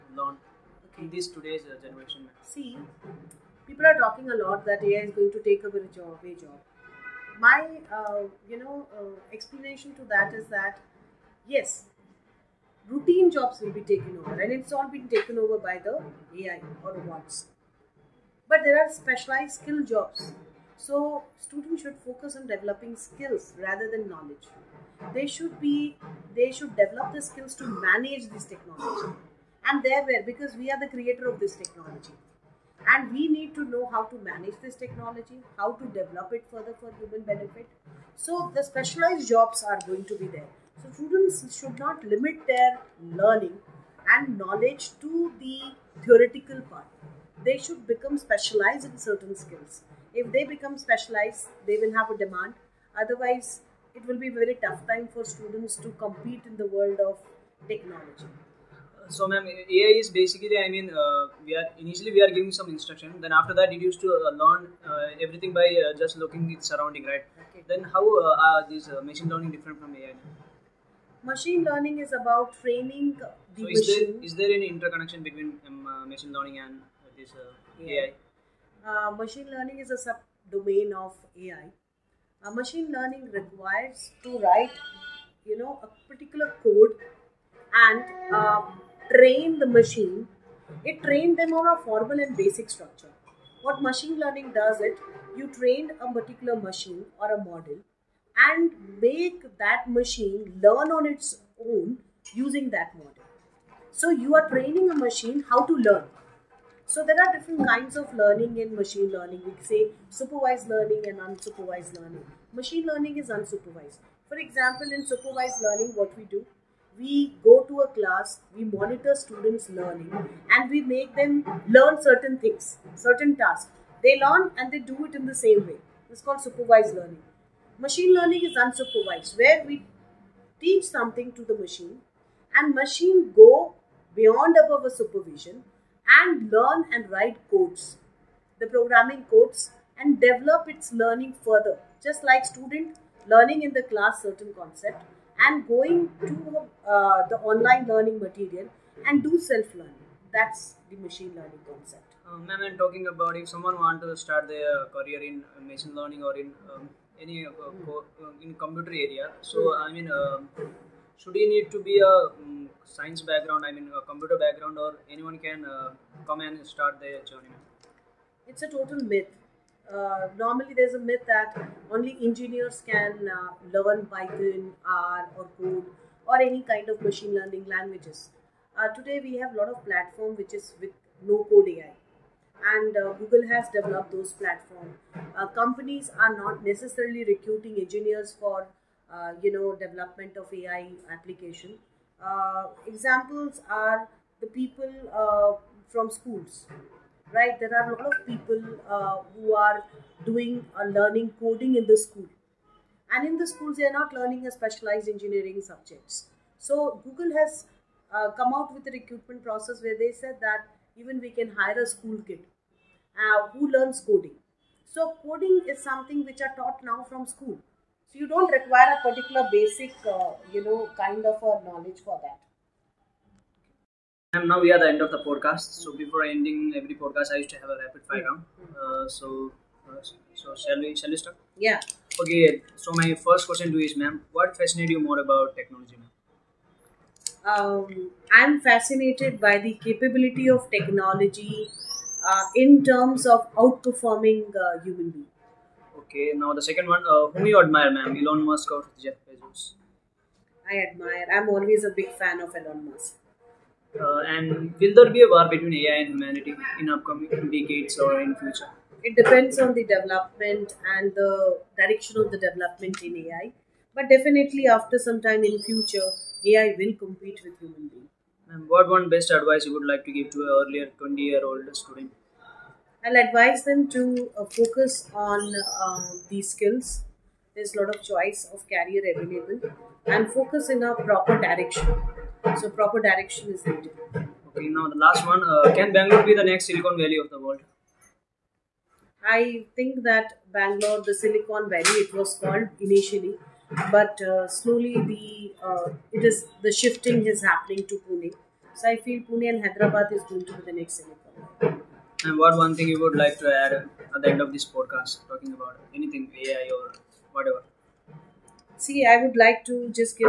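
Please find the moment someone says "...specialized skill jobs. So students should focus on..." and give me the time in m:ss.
0:18.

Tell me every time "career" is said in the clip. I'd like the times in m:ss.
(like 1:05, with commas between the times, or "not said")
2:34, 4:38.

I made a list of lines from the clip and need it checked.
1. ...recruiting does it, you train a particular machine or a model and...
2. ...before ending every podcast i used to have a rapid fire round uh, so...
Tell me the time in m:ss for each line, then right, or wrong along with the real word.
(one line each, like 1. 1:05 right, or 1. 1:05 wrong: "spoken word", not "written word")
1. 1:34 wrong: "learning", not "recruiting"
2. 3:46 right.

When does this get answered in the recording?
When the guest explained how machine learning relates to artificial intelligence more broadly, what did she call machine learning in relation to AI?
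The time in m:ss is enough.
1:20.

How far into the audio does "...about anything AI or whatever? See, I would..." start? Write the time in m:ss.
5:05.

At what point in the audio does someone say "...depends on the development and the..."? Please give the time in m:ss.
4:19.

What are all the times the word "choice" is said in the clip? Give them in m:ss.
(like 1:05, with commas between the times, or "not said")
4:38.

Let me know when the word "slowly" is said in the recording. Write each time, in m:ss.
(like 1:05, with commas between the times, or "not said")
4:54.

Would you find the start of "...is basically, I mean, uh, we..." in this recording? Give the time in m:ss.
0:59.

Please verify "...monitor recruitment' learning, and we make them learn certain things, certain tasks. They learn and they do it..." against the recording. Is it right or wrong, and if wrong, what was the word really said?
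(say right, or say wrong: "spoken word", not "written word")
wrong: "students", not "recruitment".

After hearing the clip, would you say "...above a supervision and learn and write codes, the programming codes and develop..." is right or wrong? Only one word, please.
right.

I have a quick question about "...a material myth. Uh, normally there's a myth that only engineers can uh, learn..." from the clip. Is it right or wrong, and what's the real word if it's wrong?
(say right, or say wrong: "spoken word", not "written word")
wrong: "total", not "material".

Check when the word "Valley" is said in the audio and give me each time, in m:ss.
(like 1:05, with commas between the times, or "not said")
4:46, 4:51.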